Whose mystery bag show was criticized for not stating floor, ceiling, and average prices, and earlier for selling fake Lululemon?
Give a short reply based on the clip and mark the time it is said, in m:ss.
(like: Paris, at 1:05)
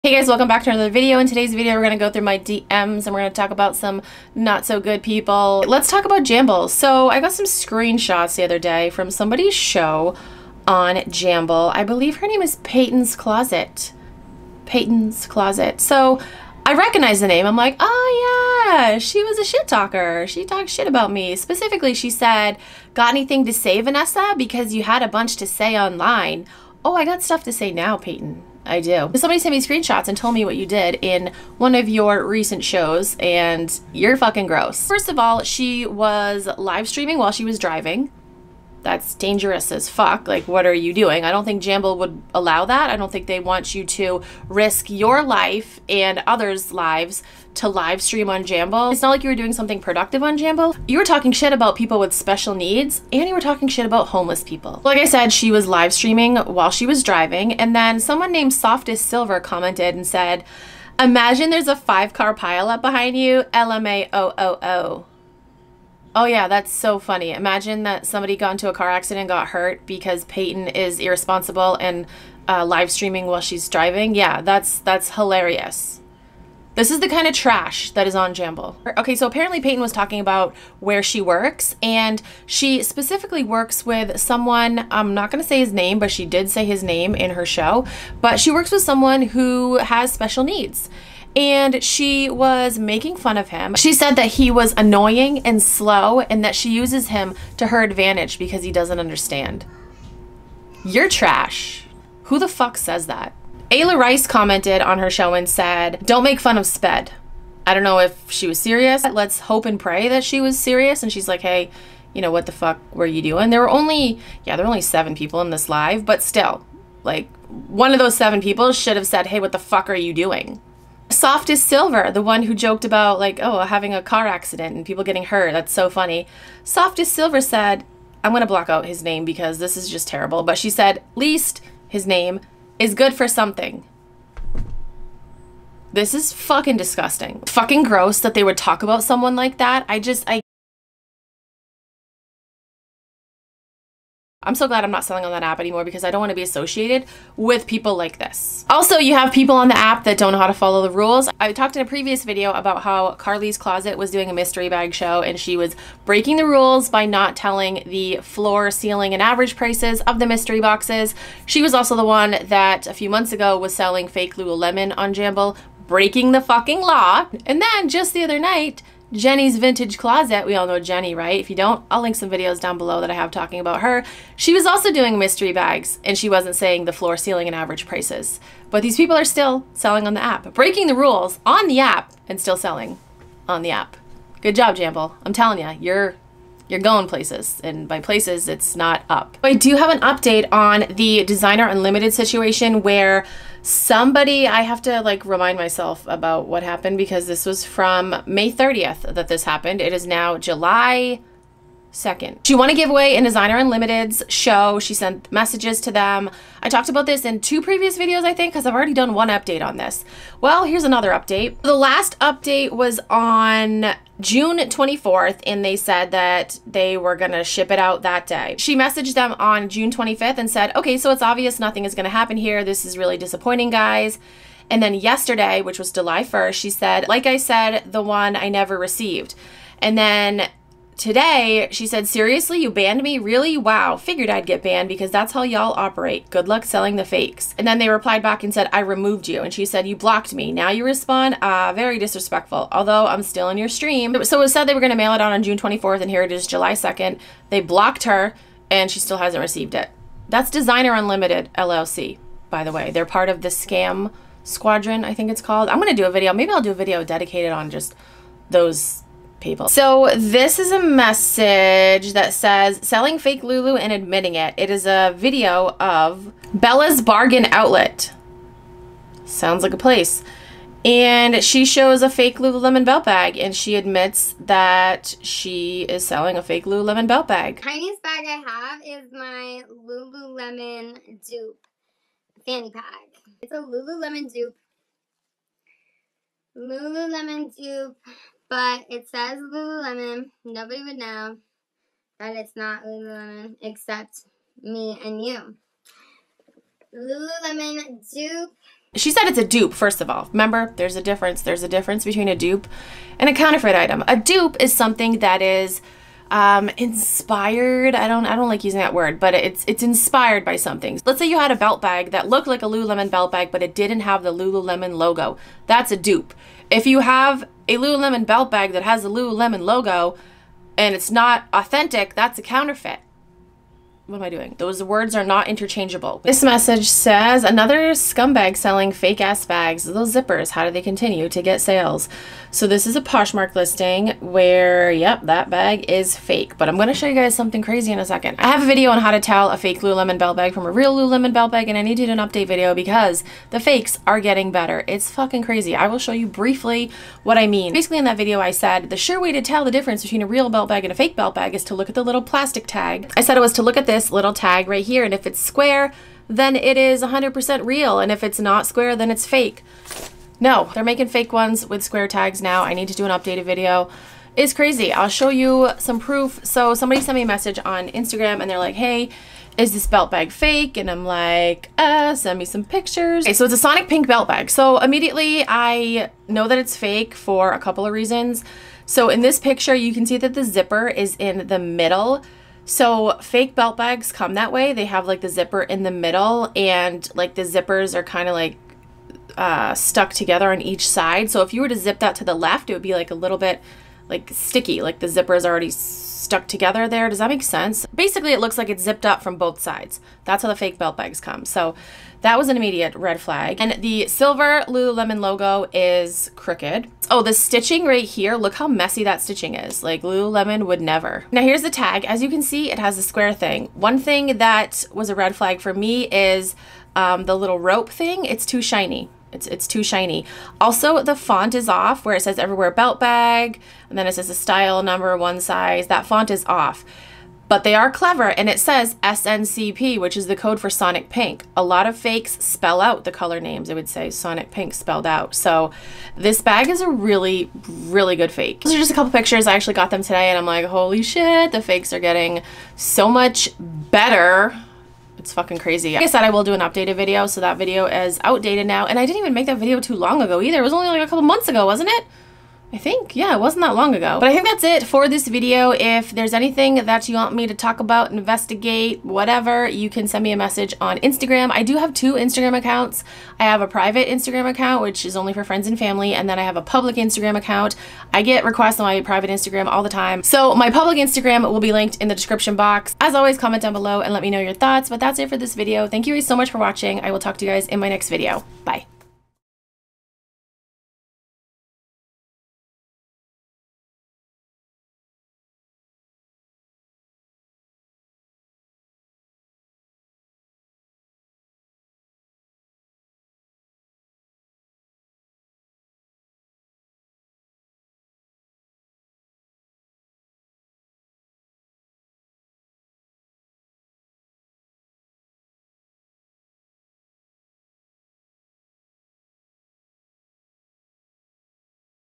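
Carly's Closet, at 2:33.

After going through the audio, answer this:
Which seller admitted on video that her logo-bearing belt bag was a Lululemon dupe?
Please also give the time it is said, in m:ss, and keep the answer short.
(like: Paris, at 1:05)
Bella's Bargain Outlet, at 4:26.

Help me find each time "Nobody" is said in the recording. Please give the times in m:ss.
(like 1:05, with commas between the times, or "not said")
4:50.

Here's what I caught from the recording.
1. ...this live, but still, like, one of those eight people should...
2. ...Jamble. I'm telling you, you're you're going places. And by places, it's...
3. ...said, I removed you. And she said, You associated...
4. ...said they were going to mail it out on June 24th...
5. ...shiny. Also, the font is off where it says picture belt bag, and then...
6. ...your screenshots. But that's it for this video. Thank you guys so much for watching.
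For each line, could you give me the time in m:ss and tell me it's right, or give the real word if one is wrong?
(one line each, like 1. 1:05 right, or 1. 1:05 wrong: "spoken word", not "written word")
1. 1:55 wrong: "seven", not "eight"
2. 3:04 right
3. 3:58 wrong: "blocked", not "associated"
4. 4:04 right
5. 6:59 wrong: "everywhere", not "picture"
6. 7:54 wrong: "thoughts", not "screenshots".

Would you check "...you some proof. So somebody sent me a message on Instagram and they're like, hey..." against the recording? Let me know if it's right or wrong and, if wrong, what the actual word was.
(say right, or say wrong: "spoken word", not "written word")
right.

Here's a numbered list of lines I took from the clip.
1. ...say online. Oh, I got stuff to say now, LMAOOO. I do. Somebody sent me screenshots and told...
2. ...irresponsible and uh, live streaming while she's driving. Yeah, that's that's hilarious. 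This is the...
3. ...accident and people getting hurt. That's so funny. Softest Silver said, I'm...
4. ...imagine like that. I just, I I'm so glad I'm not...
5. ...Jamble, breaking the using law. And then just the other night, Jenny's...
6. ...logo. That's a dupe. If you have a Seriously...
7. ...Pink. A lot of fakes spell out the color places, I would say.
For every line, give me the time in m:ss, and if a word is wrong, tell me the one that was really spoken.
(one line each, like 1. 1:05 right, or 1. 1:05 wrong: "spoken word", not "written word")
1. 0:25 wrong: "Peyton", not "LMAOOO"
2. 1:10 right
3. 2:04 right
4. 2:19 wrong: "someone", not "imagine"
5. 2:45 wrong: "fucking", not "using"
6. 5:14 wrong: "Lululemon", not "Seriously"
7. 7:11 wrong: "names", not "places".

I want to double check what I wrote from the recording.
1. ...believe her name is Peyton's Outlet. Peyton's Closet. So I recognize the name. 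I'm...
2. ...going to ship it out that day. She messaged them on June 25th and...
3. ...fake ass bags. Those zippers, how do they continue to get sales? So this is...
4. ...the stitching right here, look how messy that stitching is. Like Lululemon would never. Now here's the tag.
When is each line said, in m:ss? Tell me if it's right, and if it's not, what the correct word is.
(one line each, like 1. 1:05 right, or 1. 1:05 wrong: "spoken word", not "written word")
1. 0:11 wrong: "Closet", not "Outlet"
2. 3:37 right
3. 5:28 right
4. 6:47 right.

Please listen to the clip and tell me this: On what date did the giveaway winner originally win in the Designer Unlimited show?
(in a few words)
May 30th.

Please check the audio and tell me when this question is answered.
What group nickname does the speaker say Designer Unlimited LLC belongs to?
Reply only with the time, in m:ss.
4:13.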